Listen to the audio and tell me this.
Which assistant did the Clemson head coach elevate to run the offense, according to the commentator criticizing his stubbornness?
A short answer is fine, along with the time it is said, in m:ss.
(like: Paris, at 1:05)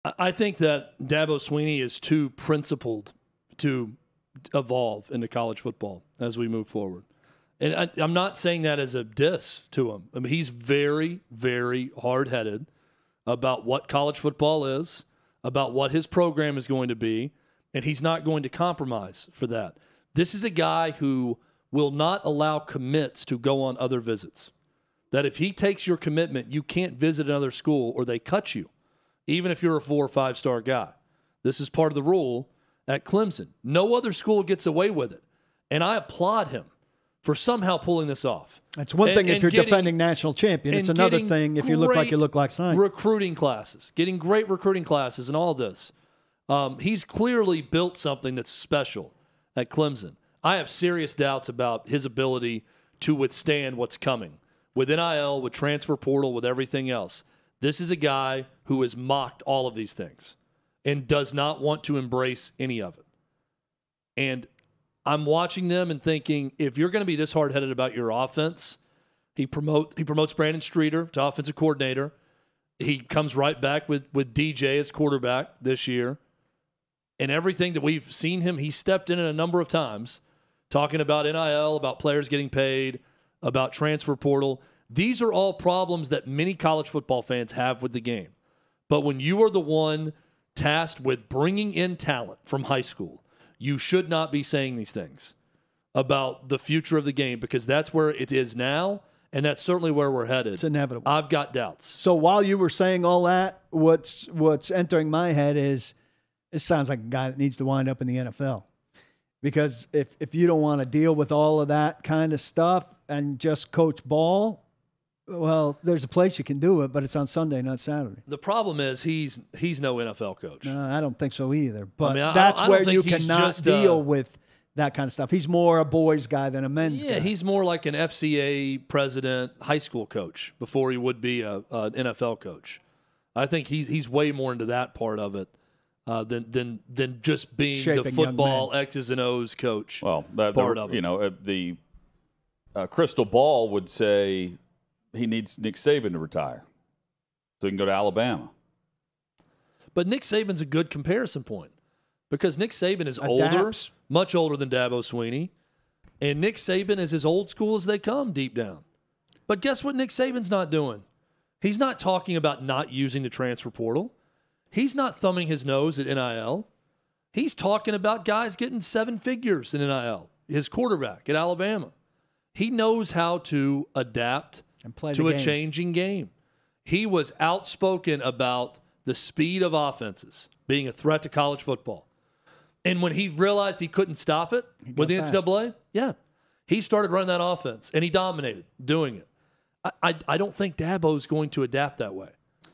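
Brandon Streeter, at 1:10.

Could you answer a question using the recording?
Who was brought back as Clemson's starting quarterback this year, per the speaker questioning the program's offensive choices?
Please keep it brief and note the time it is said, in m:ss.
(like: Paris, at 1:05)
DJ, at 1:14.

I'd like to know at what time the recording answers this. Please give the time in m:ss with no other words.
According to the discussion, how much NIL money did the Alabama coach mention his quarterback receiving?
2:48.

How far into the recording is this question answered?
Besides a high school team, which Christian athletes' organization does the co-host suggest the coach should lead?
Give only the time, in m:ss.
2:07.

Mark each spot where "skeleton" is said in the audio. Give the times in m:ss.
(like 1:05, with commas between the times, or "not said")
not said.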